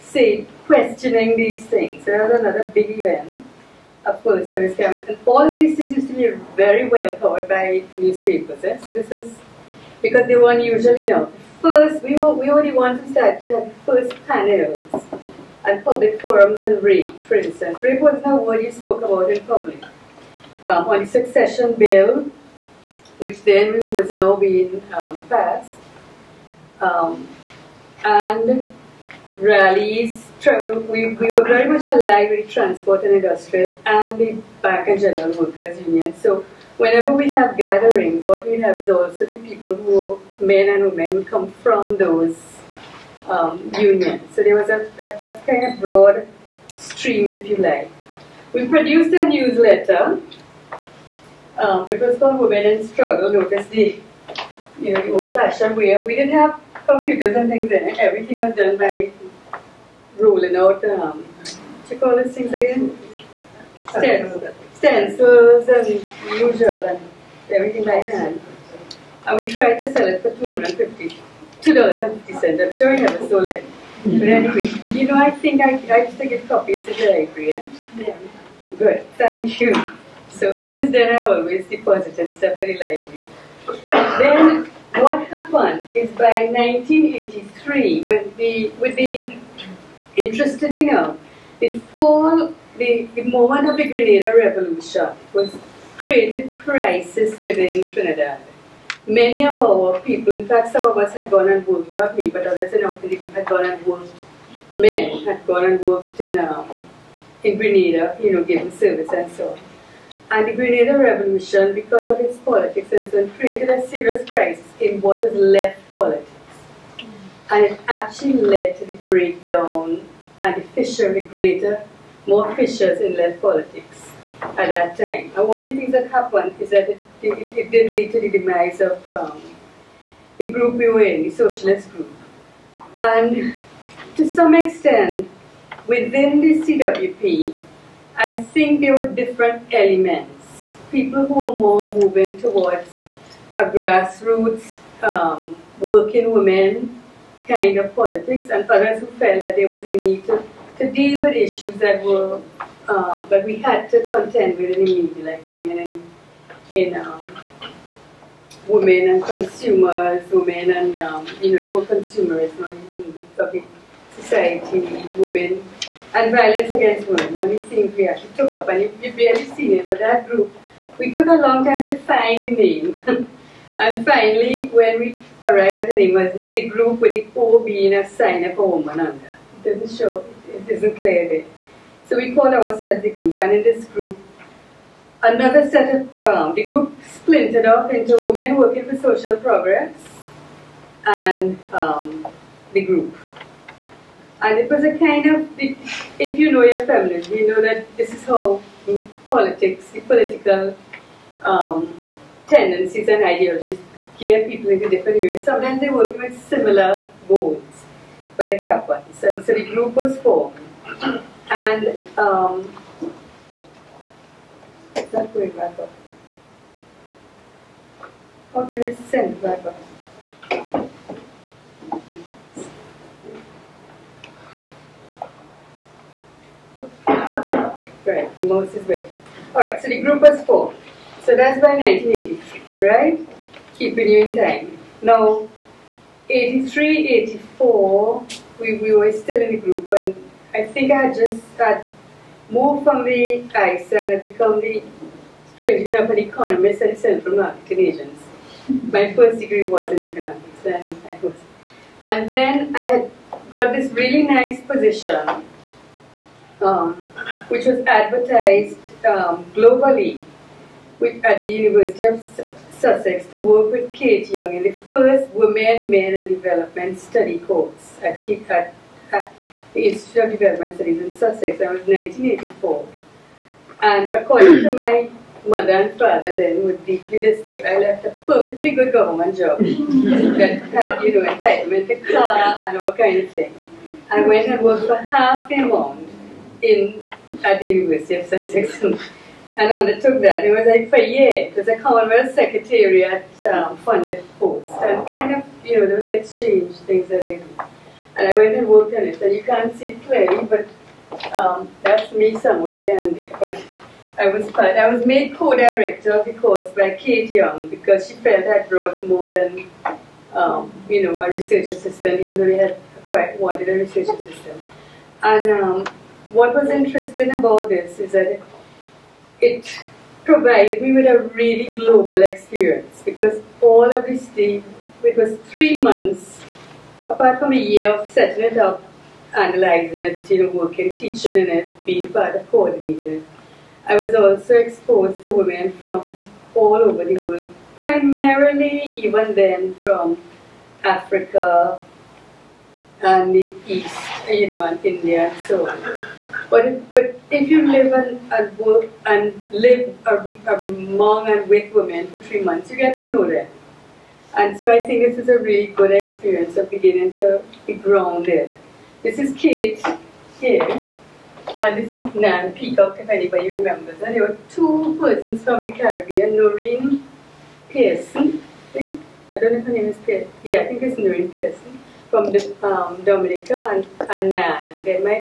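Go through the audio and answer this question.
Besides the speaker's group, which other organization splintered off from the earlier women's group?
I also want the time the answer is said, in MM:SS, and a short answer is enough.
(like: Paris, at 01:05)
Women Working for Social Progress, at 03:08.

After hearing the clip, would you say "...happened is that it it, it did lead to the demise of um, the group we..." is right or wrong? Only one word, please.
right.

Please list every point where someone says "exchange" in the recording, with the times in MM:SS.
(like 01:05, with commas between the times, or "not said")
04:56.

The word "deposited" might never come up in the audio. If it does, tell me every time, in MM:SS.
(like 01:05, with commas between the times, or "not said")
01:21.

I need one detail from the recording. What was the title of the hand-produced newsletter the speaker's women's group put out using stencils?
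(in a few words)
Women in Struggle.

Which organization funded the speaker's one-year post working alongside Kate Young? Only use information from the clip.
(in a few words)
Commonwealth Secretariat.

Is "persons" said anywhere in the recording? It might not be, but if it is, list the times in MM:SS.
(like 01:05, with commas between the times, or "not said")
06:04.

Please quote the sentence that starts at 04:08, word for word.
My first degree was in economics, and I was.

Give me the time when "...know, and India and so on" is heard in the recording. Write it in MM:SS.
05:44.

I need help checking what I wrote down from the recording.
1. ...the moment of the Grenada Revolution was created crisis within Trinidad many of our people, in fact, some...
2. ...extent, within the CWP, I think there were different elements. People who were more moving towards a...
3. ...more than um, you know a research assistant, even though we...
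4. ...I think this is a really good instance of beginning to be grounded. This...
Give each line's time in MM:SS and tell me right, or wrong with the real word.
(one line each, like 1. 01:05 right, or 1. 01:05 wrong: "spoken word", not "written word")
1. 01:33 right
2. 02:14 right
3. 05:09 right
4. 05:54 wrong: "experience", not "instance".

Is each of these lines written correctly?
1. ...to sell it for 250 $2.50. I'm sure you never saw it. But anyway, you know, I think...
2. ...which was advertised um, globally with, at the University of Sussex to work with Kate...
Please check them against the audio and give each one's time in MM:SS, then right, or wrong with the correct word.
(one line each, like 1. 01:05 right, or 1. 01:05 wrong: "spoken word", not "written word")
1. 01:09 right
2. 04:17 right.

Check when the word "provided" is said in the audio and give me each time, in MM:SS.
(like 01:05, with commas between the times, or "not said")
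05:20.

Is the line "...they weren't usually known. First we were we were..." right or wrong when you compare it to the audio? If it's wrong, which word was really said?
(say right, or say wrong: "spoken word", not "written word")
right.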